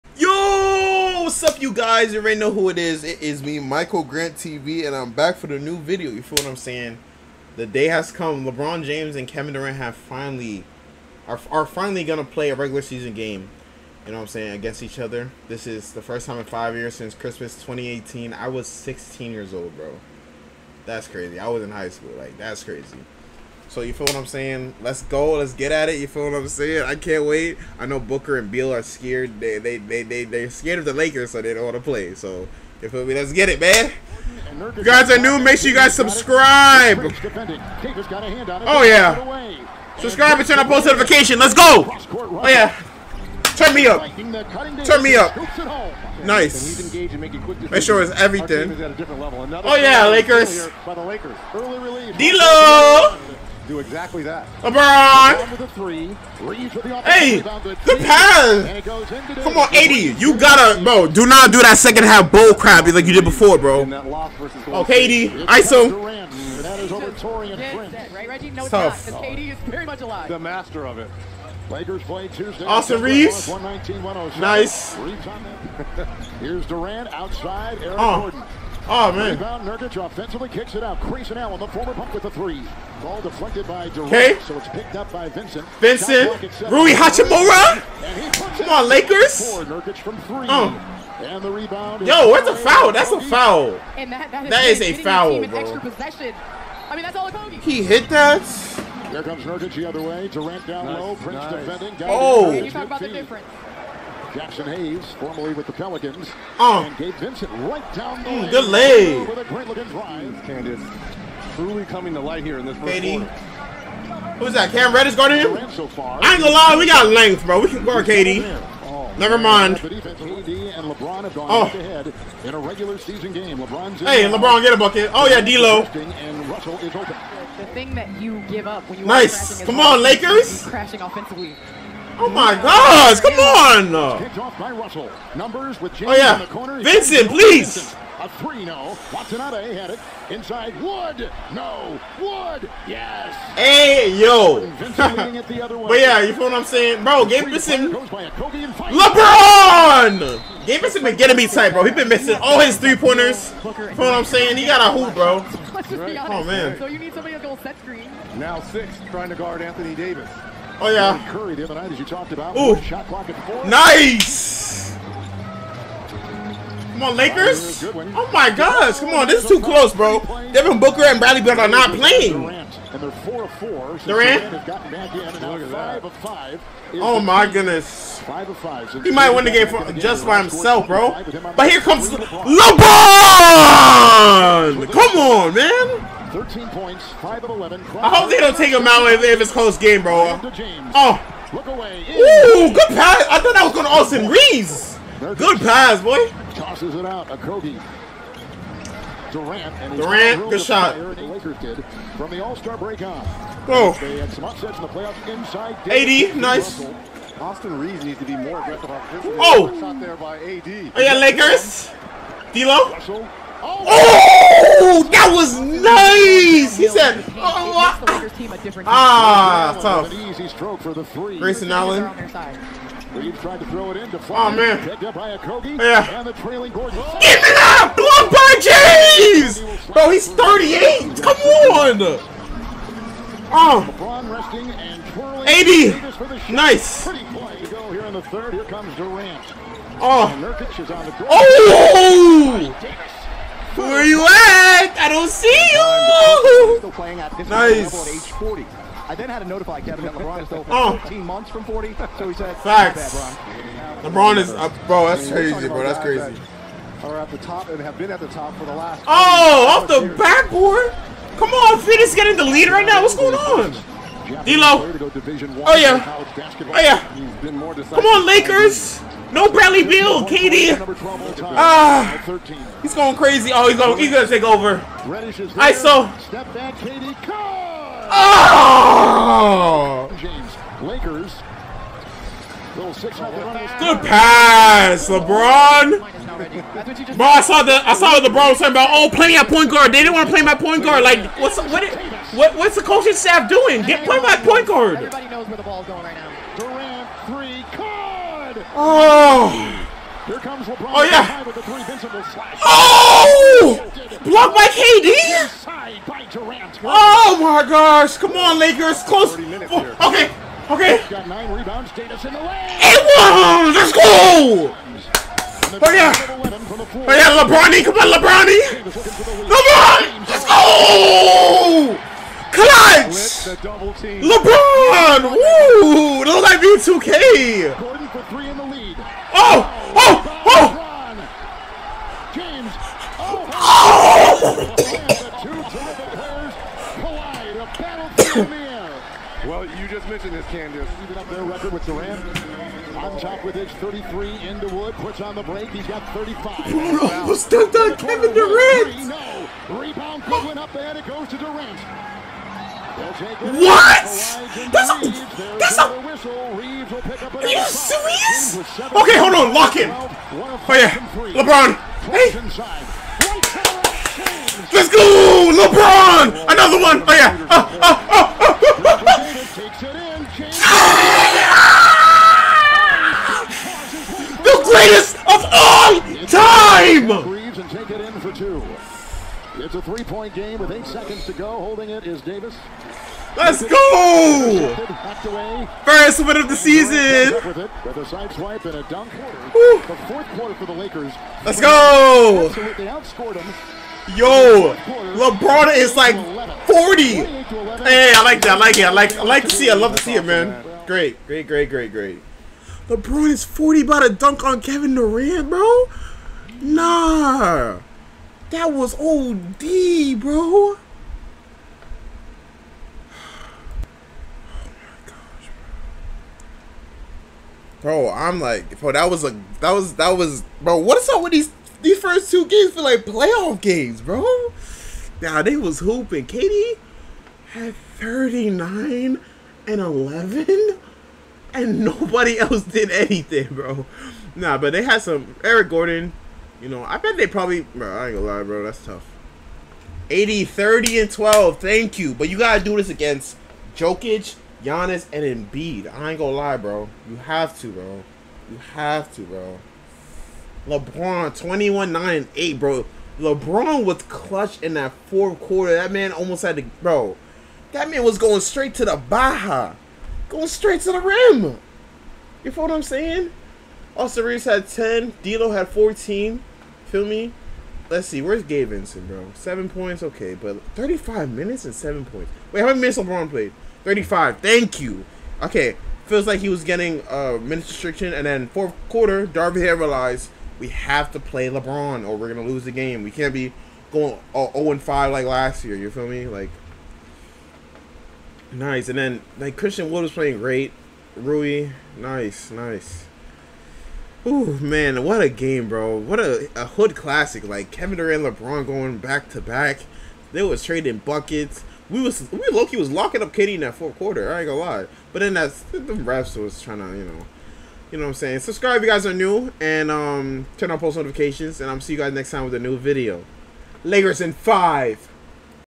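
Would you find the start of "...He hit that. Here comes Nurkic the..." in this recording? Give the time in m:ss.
1:37.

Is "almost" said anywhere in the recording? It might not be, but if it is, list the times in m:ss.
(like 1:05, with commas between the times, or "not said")
5:47, 7:36.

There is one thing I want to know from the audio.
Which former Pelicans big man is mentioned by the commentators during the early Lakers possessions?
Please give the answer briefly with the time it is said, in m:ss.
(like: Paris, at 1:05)
Jaxson Hayes, at 1:44.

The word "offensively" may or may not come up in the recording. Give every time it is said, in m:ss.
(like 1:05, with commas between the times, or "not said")
1:20, 2:11.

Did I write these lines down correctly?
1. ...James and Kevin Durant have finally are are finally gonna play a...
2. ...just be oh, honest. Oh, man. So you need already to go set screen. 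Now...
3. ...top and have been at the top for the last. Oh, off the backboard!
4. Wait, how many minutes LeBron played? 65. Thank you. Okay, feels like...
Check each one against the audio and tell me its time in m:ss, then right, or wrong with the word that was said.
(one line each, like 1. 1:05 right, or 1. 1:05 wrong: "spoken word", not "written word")
1. 0:08 right
2. 2:35 wrong: "somebody", not "already"
3. 4:17 right
4. 7:52 wrong: "35", not "65".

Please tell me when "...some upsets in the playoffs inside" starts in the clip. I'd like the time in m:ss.
3:24.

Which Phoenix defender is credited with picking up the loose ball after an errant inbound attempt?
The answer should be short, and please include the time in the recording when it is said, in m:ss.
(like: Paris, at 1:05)
Okogie, at 3:45.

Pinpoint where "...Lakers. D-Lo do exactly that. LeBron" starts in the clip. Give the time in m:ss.
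0:50.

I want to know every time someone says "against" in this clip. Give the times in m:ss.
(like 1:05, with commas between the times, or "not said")
0:14, 7:22.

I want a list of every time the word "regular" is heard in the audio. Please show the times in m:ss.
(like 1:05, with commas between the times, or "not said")
0:12, 2:02.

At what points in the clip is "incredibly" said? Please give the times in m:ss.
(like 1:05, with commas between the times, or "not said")
not said.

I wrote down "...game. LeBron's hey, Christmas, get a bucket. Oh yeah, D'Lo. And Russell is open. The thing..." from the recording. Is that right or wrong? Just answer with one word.
wrong.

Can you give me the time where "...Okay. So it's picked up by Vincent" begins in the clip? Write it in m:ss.
1:23.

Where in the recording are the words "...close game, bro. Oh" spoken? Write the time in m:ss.
3:09.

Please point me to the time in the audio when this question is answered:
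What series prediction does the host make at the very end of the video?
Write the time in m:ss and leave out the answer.
8:33.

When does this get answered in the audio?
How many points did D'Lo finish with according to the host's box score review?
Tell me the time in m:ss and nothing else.
7:45.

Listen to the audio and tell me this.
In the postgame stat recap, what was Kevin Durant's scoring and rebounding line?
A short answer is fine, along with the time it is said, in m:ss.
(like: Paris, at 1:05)
39 and 11, at 7:07.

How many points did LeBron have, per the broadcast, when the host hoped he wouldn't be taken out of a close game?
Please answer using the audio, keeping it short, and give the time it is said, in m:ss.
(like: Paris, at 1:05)
13, at 3:06.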